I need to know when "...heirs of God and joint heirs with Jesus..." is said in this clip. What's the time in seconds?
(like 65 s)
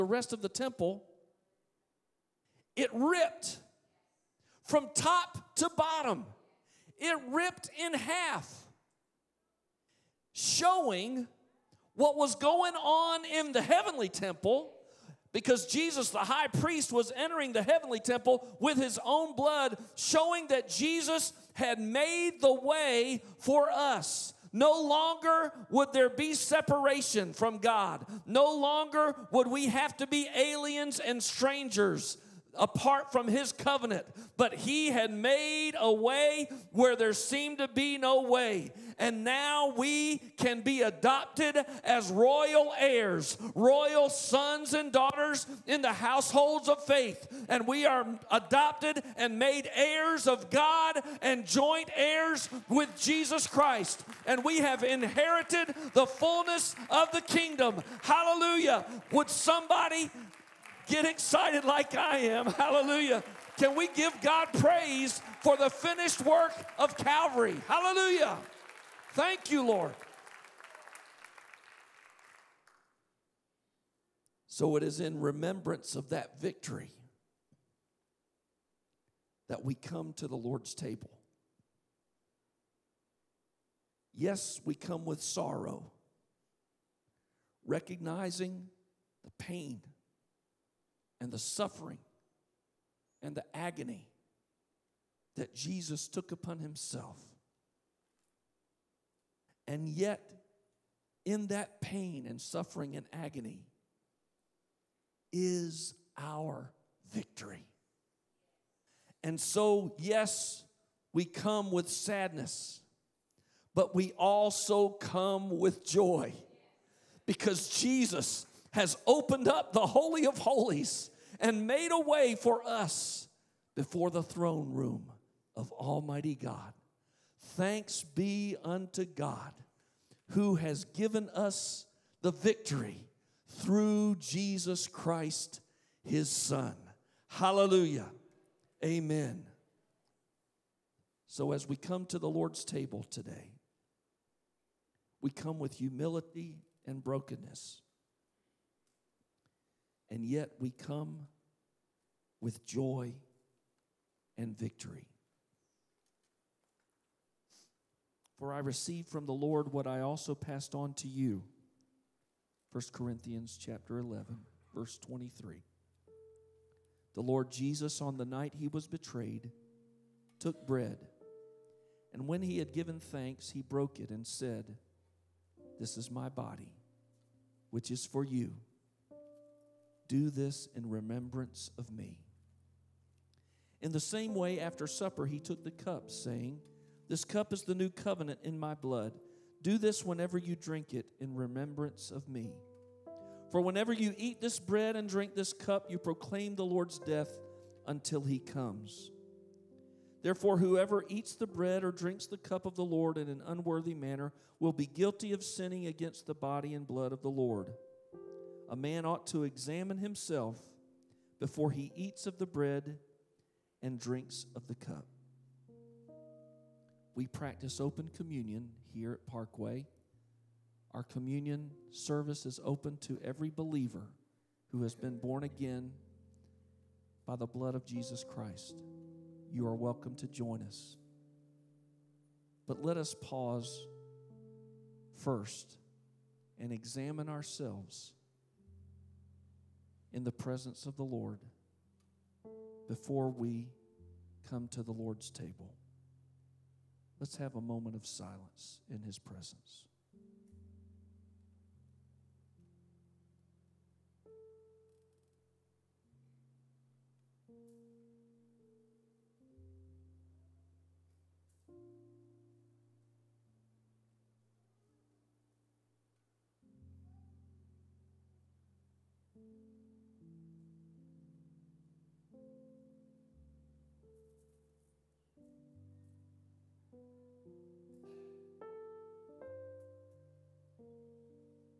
49 s.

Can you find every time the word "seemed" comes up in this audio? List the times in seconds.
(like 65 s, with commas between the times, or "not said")
37 s.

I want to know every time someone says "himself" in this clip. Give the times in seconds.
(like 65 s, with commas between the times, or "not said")
96 s, 209 s.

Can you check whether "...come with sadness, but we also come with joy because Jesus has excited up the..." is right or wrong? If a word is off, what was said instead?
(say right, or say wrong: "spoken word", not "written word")
wrong: "opened", not "excited".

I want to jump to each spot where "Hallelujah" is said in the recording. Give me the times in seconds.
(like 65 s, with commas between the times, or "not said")
58 s, 62 s, 67 s, 137 s.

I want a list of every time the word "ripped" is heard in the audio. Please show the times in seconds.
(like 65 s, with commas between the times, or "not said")
2 s, 7 s.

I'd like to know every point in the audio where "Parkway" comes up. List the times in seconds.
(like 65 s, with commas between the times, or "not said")
219 s.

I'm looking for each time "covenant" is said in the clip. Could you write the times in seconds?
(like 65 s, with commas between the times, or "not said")
33 s, 187 s.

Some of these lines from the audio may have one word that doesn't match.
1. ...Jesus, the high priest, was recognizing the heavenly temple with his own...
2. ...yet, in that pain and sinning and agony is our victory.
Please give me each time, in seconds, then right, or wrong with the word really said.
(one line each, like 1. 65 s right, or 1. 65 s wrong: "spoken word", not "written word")
1. 15 s wrong: "entering", not "recognizing"
2. 99 s wrong: "suffering", not "sinning".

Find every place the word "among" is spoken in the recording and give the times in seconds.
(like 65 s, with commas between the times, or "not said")
not said.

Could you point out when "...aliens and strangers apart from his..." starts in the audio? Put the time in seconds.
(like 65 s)
30 s.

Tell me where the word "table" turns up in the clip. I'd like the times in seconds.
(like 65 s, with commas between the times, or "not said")
80 s, 142 s, 245 s.